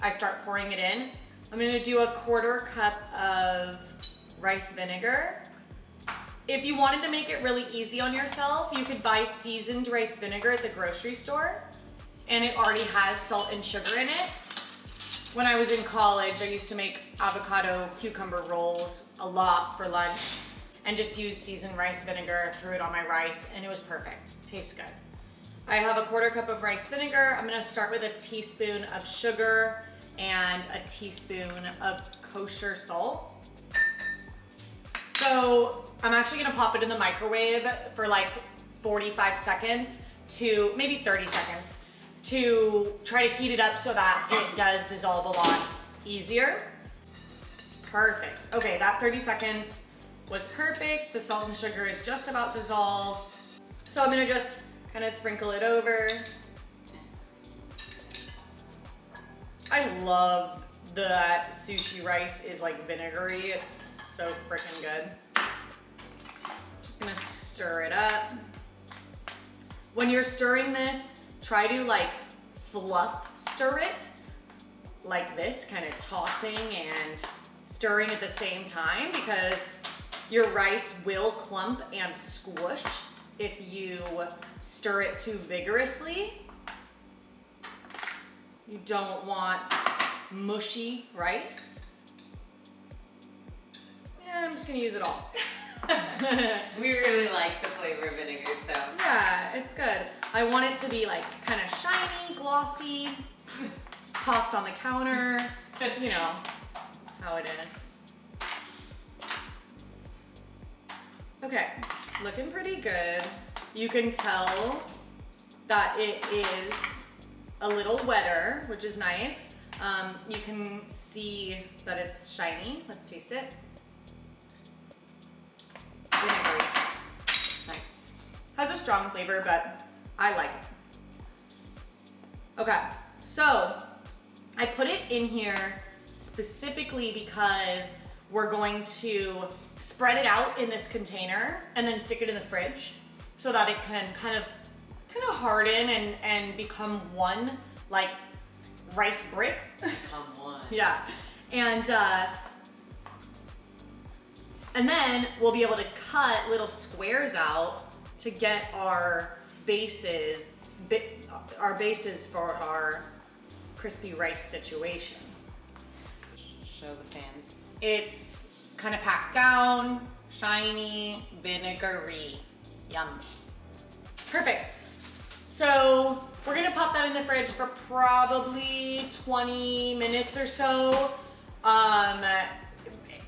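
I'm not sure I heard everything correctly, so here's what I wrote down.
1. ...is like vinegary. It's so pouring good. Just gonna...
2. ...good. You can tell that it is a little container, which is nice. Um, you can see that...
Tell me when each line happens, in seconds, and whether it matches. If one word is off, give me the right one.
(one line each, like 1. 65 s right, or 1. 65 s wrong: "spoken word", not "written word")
1. 62 s wrong: "freaking", not "pouring"
2. 112 s wrong: "wetter", not "container".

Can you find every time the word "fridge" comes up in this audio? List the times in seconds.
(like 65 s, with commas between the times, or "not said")
142 s, 177 s.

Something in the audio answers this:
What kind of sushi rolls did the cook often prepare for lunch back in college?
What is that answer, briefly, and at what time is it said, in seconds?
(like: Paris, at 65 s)
avocado cucumber rolls, at 17 s.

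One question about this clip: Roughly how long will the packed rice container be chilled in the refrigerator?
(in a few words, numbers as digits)
20 minutes.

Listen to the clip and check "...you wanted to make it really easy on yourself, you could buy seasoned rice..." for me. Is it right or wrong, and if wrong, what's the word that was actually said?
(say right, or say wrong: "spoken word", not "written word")
right.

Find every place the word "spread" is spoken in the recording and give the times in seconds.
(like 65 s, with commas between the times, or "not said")
139 s.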